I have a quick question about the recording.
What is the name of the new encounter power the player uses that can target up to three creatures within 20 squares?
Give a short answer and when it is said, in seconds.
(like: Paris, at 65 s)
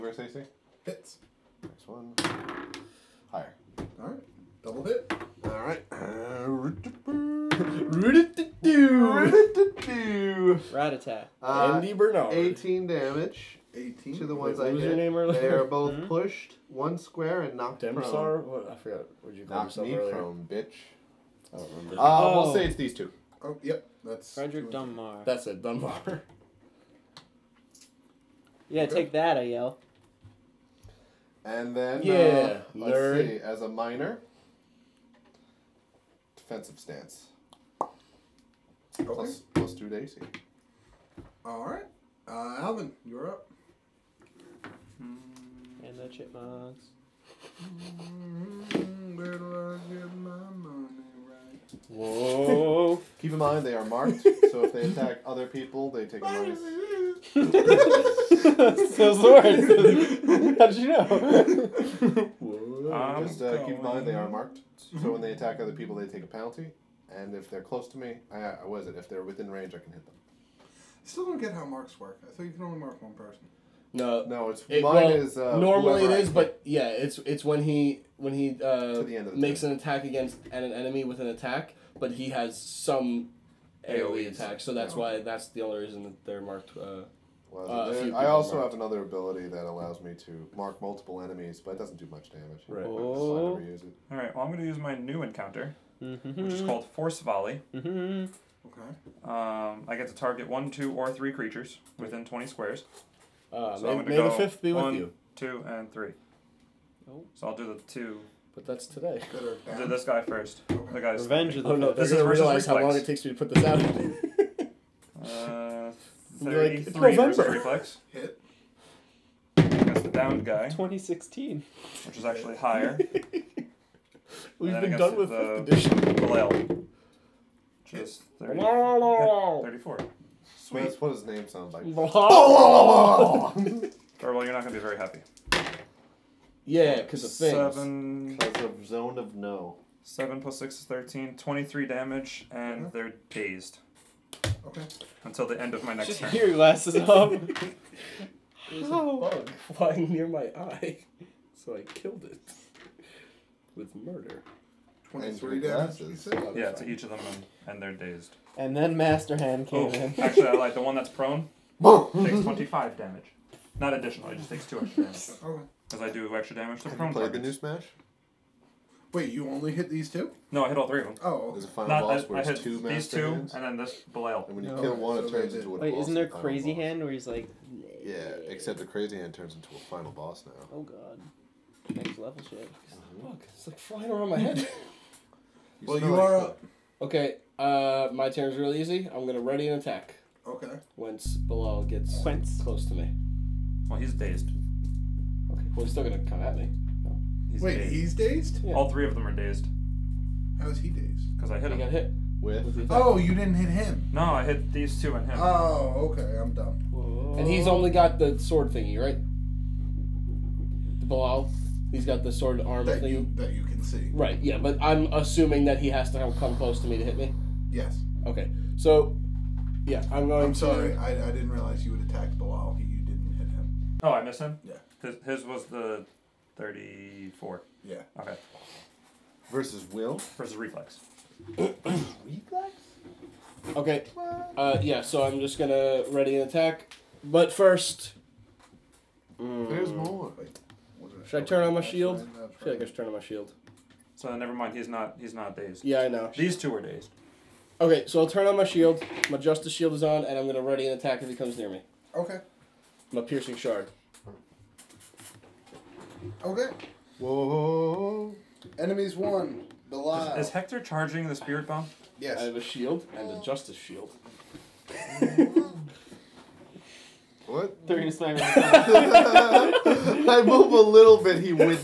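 Force Volley, at 96 s.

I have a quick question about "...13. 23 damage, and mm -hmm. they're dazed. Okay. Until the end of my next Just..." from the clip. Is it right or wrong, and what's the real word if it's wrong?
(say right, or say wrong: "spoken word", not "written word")
right.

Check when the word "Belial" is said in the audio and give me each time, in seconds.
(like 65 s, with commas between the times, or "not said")
174 s, 259 s.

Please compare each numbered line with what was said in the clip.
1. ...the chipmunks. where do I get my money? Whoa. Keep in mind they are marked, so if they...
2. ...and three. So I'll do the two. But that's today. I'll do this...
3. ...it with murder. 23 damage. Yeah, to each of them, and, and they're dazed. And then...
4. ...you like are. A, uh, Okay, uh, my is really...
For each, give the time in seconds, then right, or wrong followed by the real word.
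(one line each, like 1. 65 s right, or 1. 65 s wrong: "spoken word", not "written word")
1. 45 s right
2. 105 s right
3. 152 s right
4. 185 s right.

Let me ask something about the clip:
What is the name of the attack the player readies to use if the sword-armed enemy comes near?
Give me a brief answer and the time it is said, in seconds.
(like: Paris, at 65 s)
Piercing Shard, at 253 s.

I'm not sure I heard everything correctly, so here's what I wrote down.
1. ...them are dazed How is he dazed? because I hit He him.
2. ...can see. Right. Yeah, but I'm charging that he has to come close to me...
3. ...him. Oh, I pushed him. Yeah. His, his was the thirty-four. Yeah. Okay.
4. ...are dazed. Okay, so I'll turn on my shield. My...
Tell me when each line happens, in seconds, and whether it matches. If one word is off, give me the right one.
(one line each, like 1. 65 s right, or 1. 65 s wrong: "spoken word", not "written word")
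1. 199 s right
2. 213 s wrong: "assuming", not "charging"
3. 223 s wrong: "missed", not "pushed"
4. 246 s right.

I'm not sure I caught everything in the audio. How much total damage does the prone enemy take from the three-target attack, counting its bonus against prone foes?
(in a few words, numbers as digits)
25.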